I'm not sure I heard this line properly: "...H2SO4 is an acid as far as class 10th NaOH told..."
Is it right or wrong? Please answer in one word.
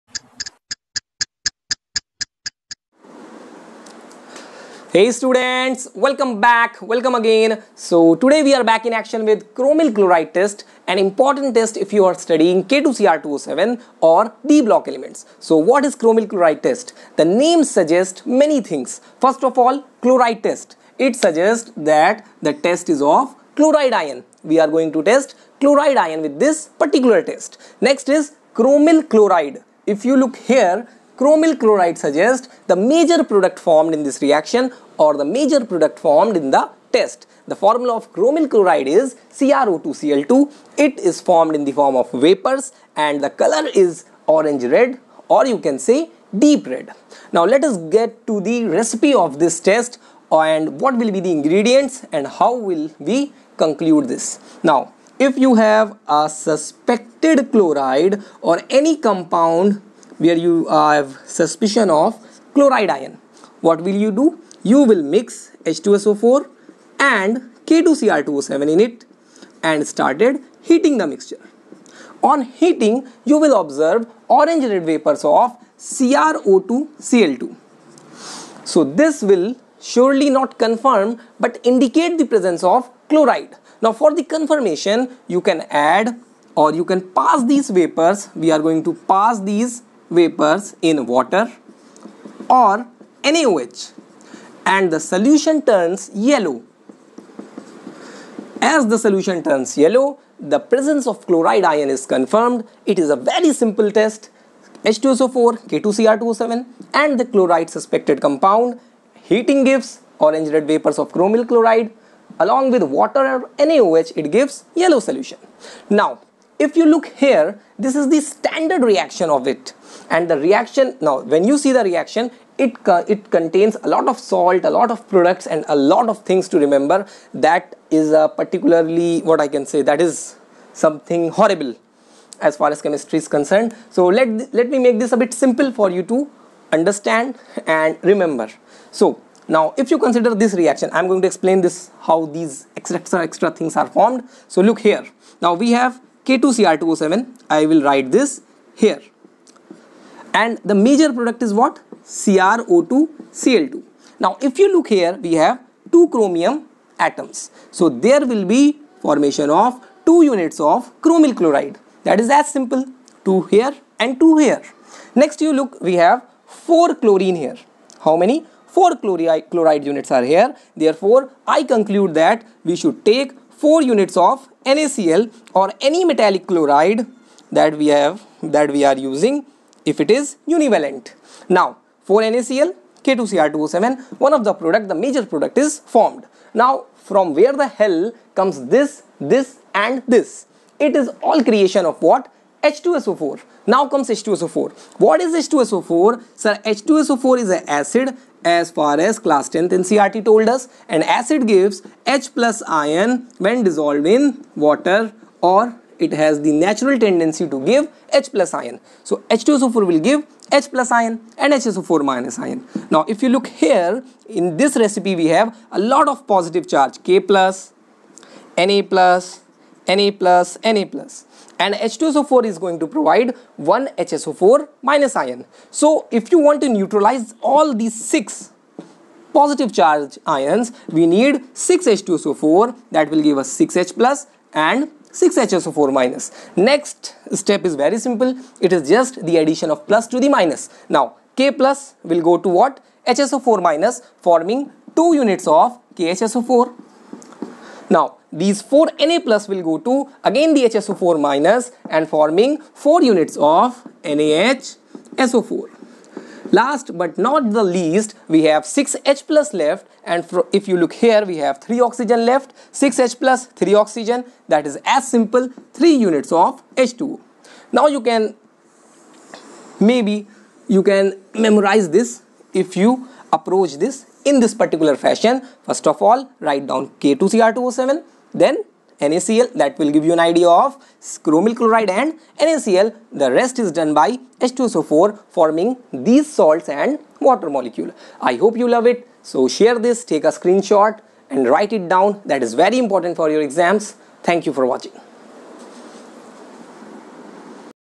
wrong.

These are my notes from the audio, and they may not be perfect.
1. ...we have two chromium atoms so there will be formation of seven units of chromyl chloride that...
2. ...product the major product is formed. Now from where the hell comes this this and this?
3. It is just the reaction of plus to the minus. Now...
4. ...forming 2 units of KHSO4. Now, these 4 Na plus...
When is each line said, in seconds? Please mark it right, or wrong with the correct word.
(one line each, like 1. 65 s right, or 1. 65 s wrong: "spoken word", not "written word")
1. 155 s wrong: "two", not "seven"
2. 184 s right
3. 238 s wrong: "addition", not "reaction"
4. 244 s right.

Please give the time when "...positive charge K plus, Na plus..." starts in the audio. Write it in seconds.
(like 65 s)
216 s.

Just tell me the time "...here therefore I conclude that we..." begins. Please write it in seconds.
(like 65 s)
170 s.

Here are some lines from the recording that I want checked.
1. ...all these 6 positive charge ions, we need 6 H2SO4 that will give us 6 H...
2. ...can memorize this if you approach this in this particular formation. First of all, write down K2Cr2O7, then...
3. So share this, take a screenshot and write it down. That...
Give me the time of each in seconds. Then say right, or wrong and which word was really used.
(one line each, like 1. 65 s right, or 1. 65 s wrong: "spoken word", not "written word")
1. 227 s right
2. 270 s wrong: "fashion", not "formation"
3. 289 s right.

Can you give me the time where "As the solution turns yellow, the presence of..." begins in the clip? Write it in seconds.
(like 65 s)
98 s.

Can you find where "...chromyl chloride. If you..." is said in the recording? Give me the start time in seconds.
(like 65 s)
28 s.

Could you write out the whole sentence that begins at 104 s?
H2SO4, k 2 cr 7 and the chloride suspected compound.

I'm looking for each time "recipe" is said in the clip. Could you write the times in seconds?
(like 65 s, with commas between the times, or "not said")
48 s, 214 s.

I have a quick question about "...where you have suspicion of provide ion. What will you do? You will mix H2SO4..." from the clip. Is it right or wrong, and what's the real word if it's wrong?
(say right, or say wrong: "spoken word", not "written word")
wrong: "chloride", not "provide".